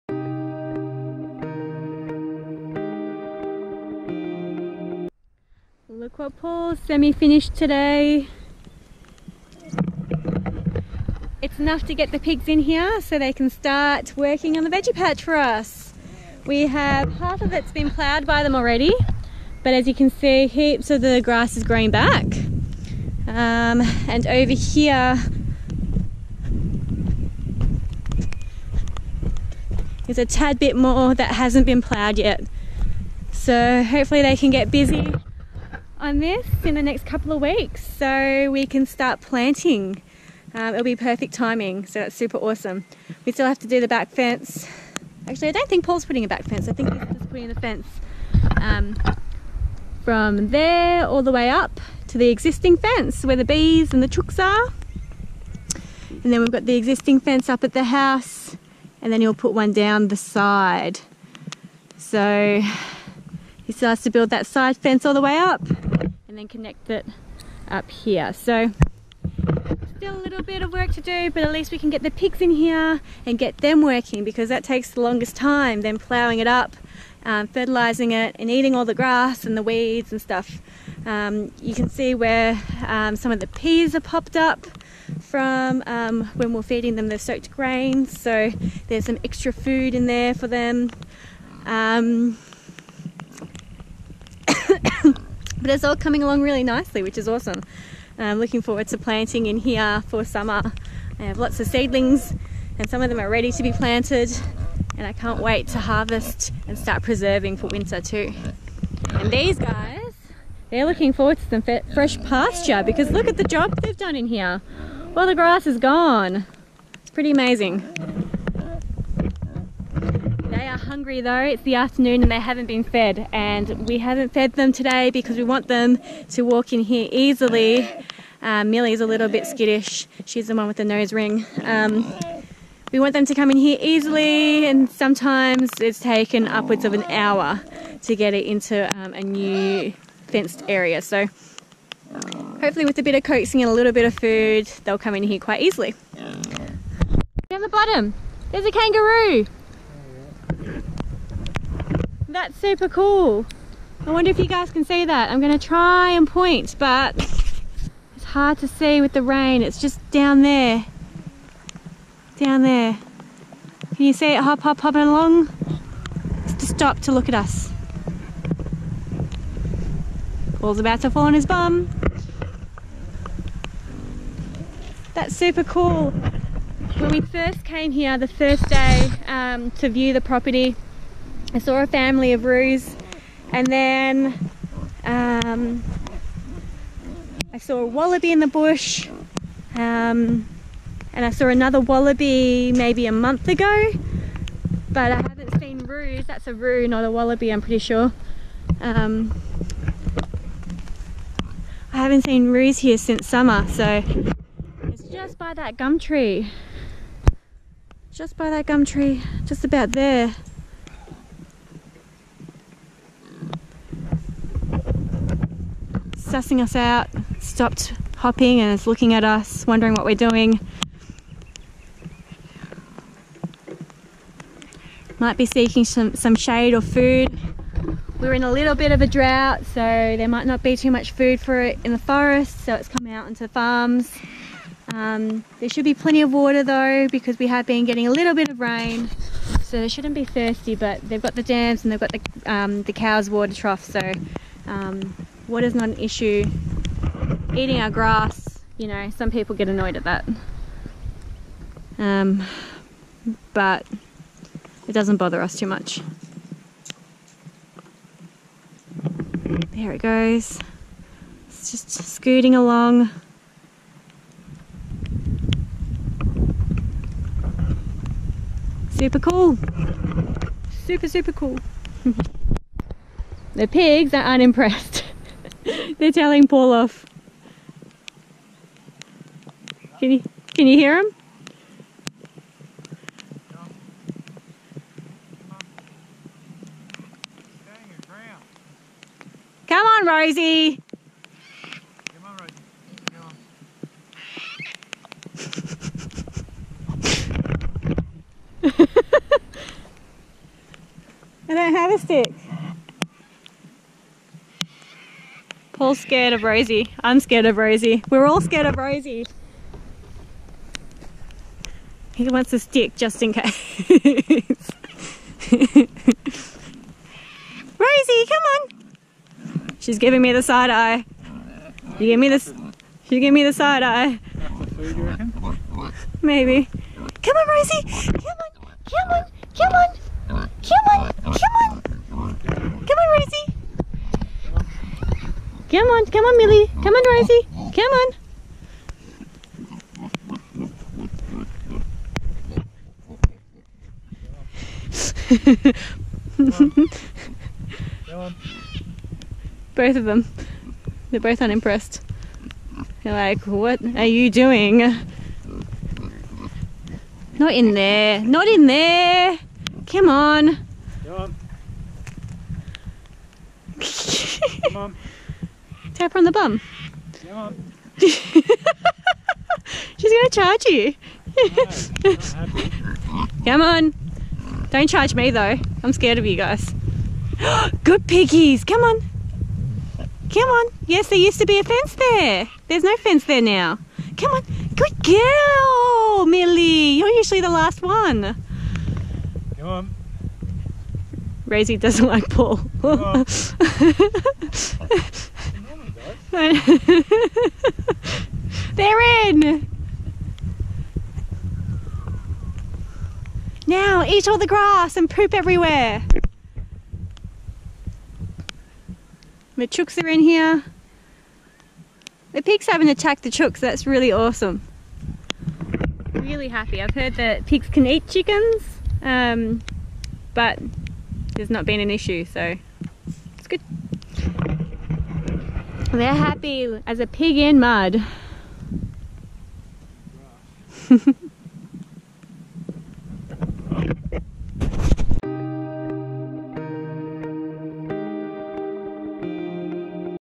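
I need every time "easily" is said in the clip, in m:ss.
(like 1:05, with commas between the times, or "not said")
2:07, 2:13, 2:25.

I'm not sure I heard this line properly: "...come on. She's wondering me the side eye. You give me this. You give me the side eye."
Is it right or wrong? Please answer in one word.
wrong.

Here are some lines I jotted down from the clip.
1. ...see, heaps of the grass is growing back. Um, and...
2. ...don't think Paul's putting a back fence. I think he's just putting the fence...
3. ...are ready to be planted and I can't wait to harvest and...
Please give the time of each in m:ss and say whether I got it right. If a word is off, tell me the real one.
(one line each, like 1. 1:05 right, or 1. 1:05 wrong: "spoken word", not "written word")
1. 0:20 right
2. 0:45 right
3. 1:43 right.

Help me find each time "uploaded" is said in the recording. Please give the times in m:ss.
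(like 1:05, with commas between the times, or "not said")
not said.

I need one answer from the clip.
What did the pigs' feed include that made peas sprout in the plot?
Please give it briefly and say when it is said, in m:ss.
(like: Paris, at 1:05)
Soaked grains, at 1:27.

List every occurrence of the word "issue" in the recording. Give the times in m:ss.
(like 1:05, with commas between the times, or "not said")
4:05, 7:01.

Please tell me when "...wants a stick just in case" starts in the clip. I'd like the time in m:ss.
5:12.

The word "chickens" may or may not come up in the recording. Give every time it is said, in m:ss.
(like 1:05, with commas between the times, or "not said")
6:58.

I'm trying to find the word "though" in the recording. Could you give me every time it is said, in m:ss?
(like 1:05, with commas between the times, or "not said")
2:01, 3:56, 6:15.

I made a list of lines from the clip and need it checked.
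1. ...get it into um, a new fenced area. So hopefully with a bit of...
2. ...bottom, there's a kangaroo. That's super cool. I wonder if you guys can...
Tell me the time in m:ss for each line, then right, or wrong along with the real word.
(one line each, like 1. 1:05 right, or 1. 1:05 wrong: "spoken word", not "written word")
1. 2:18 right
2. 2:27 right.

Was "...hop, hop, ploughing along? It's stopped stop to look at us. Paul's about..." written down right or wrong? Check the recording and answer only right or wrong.
wrong.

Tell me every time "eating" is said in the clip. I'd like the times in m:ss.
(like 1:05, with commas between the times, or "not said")
1:18, 4:07.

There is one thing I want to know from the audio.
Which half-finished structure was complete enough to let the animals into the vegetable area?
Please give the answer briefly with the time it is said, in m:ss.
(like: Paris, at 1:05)
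Aqua Pool, at 0:06.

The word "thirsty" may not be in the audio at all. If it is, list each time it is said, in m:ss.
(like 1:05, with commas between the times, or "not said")
4:00.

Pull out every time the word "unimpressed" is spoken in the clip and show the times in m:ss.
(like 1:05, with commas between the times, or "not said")
4:34, 5:51.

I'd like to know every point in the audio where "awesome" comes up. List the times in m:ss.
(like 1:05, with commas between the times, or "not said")
0:42, 1:37, 6:54.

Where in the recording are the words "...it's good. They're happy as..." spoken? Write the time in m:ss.
7:03.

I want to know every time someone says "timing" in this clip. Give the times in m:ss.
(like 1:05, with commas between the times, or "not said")
0:41.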